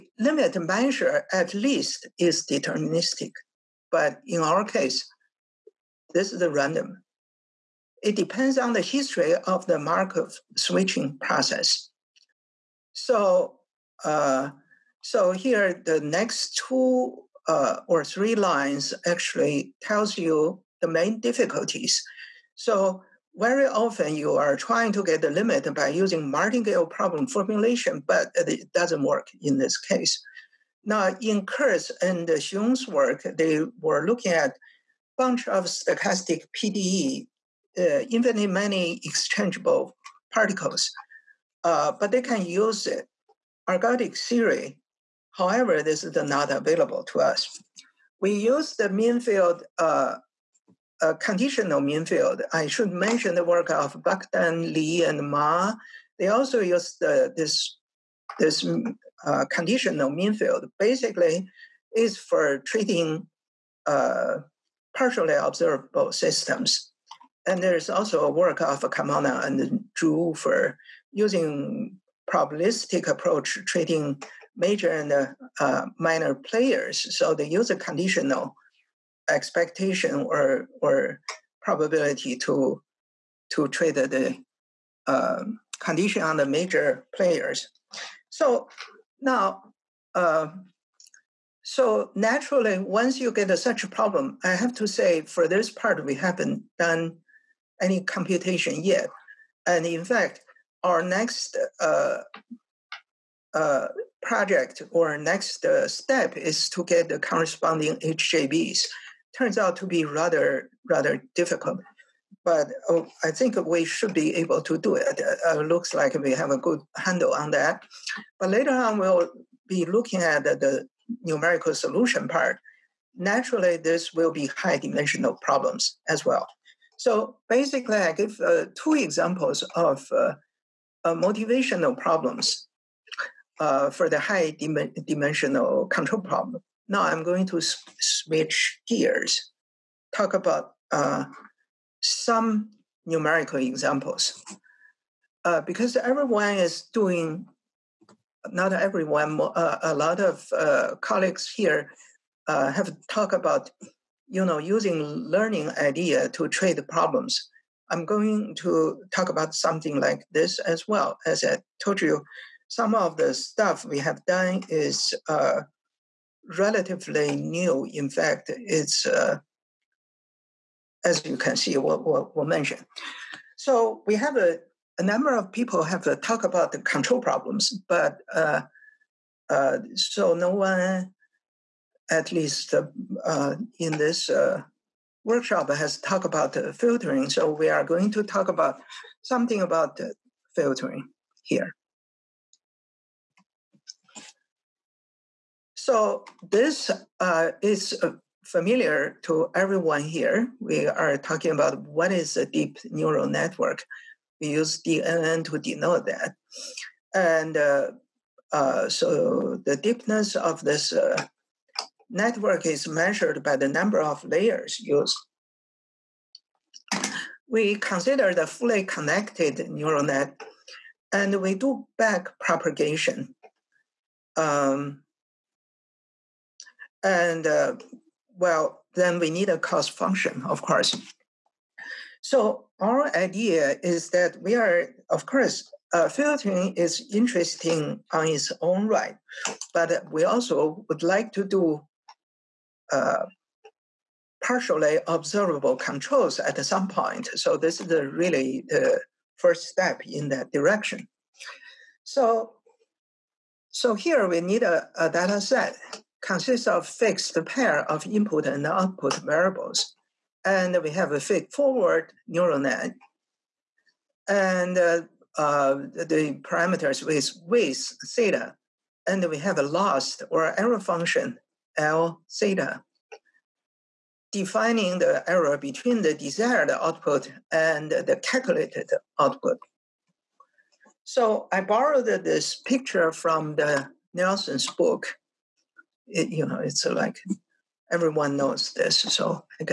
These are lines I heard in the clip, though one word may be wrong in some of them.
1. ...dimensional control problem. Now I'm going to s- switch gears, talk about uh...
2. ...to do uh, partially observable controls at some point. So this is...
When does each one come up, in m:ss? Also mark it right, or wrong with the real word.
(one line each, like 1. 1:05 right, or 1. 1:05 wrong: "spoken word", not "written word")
1. 2:15 right
2. 4:01 right.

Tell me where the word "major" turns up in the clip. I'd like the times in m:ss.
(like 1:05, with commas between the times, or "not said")
1:14, 1:26.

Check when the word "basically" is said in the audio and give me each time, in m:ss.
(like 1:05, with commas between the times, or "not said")
1:00, 2:07.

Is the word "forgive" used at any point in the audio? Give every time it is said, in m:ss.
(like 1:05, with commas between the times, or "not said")
not said.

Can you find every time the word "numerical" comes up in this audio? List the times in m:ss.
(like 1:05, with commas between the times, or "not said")
2:01, 2:23.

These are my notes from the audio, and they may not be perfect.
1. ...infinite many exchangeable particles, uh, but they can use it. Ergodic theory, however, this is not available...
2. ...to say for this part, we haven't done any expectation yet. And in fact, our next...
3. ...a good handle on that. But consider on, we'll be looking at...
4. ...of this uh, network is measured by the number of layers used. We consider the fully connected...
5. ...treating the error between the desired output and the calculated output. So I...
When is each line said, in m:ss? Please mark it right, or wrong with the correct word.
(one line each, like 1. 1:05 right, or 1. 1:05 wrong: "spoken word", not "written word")
1. 0:38 right
2. 1:34 wrong: "computation", not "expectation"
3. 1:56 wrong: "later", not "consider"
4. 3:30 right
5. 4:34 wrong: "defining", not "treating".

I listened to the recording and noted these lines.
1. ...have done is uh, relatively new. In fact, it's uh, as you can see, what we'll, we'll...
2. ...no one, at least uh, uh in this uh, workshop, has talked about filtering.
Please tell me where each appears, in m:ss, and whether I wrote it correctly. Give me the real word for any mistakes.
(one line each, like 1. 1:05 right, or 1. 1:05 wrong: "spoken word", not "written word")
1. 2:43 right
2. 3:00 right.